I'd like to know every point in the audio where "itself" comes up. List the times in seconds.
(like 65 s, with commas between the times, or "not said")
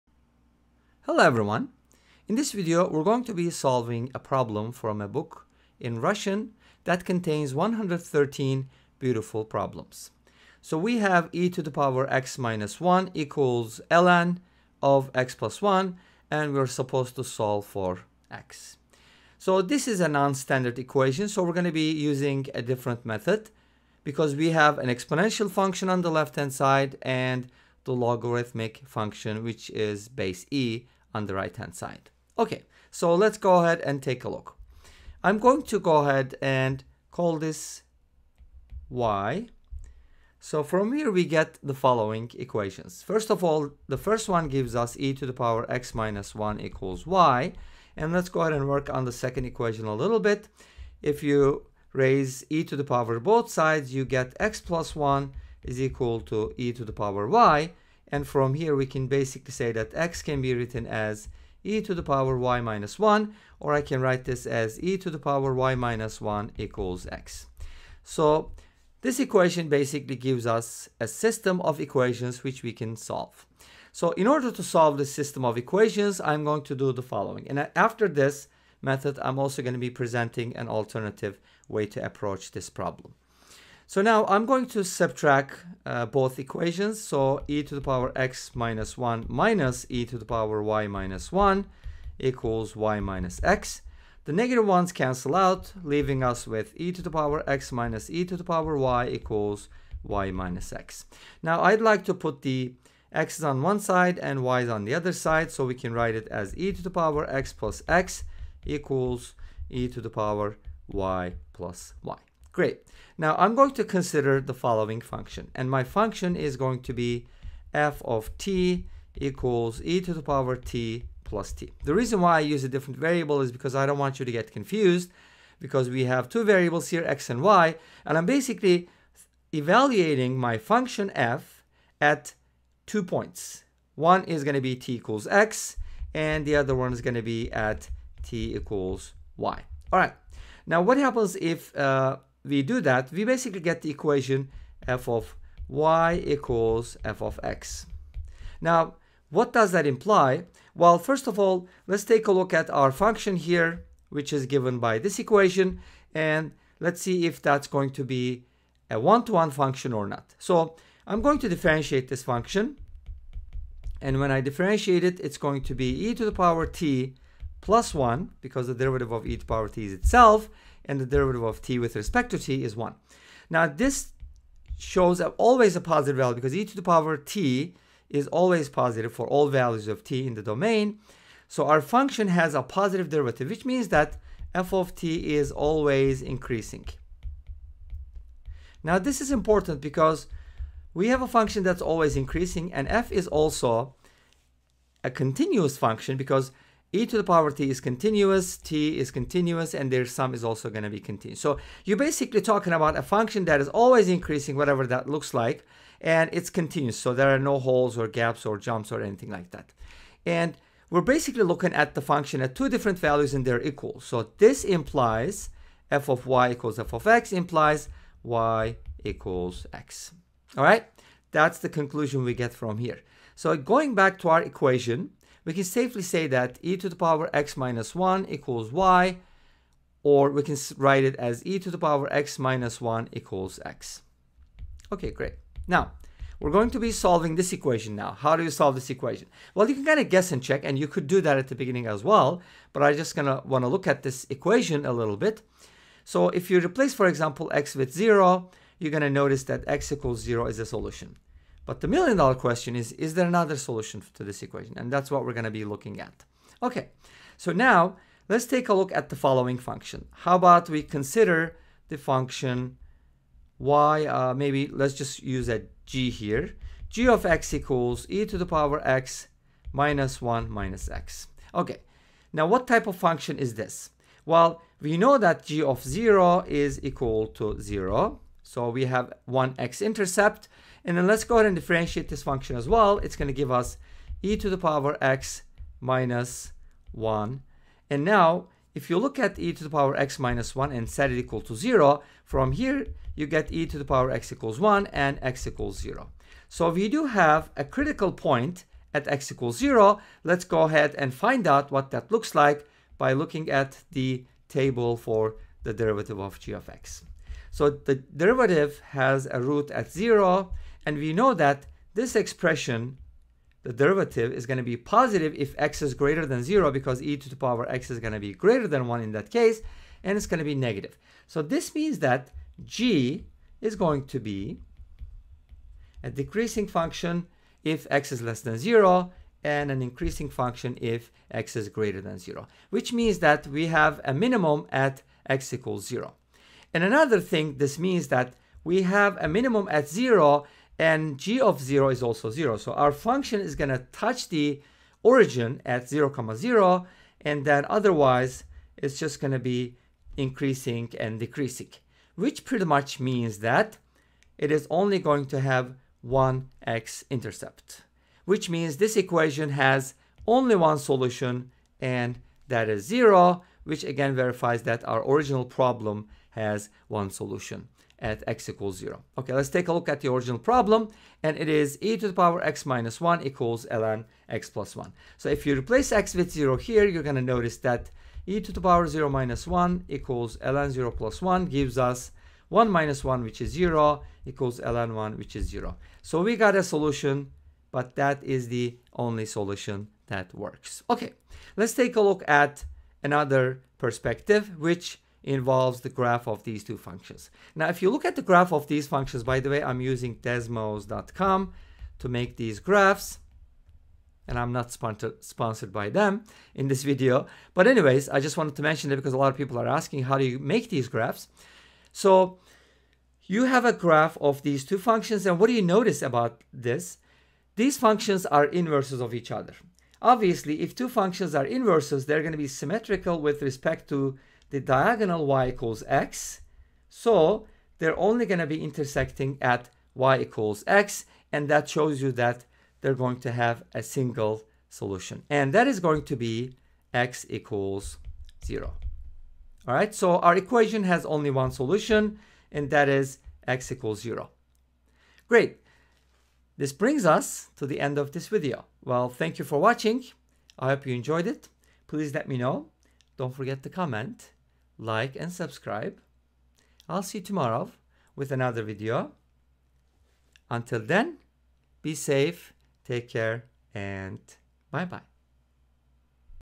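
169 s.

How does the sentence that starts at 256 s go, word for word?
Okay, so now let's take a look at the following function.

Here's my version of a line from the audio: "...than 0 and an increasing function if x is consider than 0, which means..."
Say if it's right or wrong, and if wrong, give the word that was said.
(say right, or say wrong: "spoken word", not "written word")
wrong: "greater", not "consider".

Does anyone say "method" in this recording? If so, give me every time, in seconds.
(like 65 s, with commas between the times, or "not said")
23 s, 78 s.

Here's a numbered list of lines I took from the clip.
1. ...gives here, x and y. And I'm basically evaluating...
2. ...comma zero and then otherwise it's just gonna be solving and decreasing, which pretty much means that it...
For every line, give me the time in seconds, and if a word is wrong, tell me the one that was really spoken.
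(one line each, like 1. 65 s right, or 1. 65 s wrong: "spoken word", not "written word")
1. 126 s wrong: "variables", not "gives"
2. 346 s wrong: "increasing", not "solving".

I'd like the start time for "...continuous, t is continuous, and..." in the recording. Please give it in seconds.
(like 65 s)
197 s.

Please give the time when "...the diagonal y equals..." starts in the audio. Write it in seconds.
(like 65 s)
424 s.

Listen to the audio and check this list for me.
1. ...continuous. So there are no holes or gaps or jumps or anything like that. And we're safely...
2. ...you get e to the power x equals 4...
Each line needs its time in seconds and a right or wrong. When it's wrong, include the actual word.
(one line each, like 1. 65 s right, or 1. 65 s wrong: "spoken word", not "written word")
1. 206 s wrong: "basically", not "safely"
2. 293 s wrong: "1", not "4".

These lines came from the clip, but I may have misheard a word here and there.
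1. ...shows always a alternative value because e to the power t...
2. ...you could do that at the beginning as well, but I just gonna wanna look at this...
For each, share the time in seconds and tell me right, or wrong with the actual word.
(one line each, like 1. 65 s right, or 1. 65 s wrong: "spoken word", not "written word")
1. 174 s wrong: "positive", not "alternative"
2. 240 s right.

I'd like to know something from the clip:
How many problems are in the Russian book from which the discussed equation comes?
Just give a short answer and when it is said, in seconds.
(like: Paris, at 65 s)
113, at 7 s.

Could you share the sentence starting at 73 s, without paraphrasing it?
So in order to solve this system of equations, I'm going to do the following.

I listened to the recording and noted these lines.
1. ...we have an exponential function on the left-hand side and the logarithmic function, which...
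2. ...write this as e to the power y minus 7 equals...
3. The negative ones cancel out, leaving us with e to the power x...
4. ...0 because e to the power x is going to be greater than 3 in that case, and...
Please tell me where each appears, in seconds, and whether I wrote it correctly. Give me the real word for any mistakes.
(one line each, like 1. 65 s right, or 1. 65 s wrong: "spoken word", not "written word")
1. 24 s right
2. 64 s wrong: "1", not "7"
3. 94 s right
4. 316 s wrong: "1", not "3".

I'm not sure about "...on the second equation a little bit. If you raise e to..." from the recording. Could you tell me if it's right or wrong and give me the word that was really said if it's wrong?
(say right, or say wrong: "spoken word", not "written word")
right.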